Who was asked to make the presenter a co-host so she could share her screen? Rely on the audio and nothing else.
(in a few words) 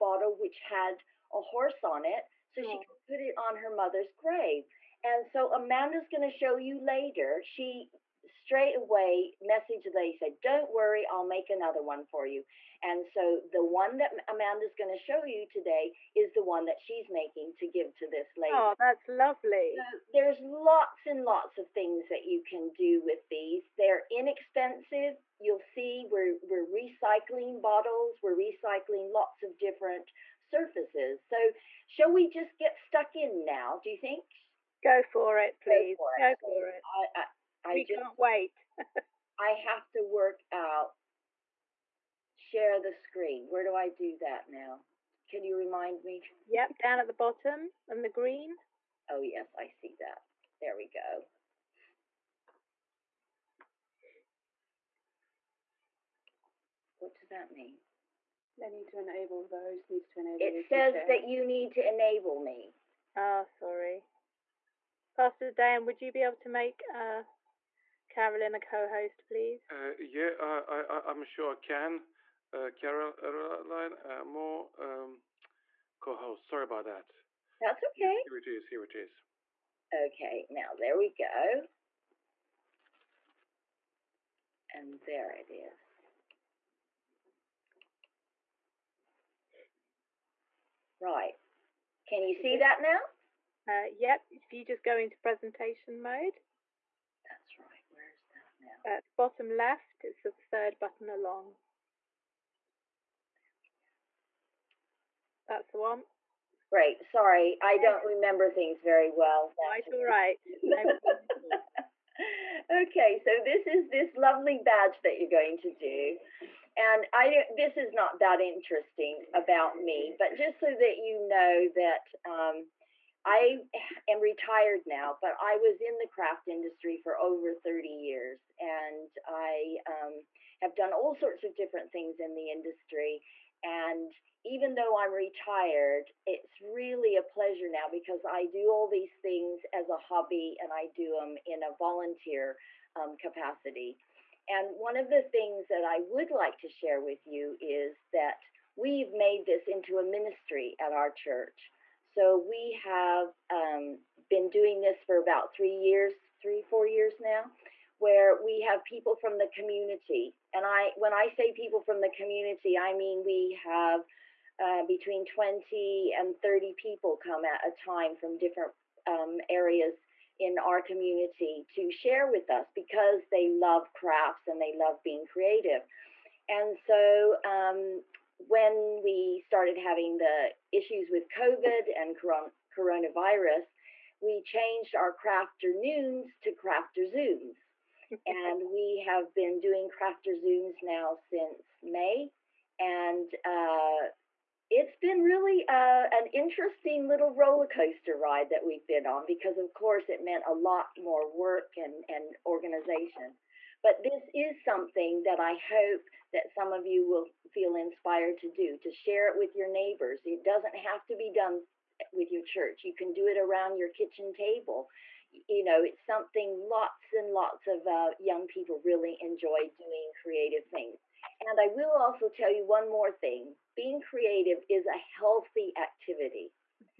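Pastor Dan.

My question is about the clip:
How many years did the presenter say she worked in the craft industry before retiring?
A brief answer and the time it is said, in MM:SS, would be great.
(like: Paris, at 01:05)
Over 30 years, at 02:07.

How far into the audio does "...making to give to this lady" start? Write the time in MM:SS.
00:17.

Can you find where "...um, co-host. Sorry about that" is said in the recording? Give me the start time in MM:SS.
01:14.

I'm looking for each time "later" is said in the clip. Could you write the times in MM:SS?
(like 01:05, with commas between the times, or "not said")
00:06.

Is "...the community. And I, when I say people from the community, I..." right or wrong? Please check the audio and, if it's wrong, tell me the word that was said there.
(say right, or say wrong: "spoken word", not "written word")
right.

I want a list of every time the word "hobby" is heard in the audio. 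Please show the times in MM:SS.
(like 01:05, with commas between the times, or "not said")
02:19.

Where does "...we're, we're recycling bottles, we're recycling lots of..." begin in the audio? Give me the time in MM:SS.
00:26.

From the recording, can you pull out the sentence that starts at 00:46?
Yep, down at the bottom and the green.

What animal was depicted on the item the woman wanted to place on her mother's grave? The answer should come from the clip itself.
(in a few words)
Horse.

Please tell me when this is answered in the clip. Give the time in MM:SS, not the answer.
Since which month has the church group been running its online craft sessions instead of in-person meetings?
03:11.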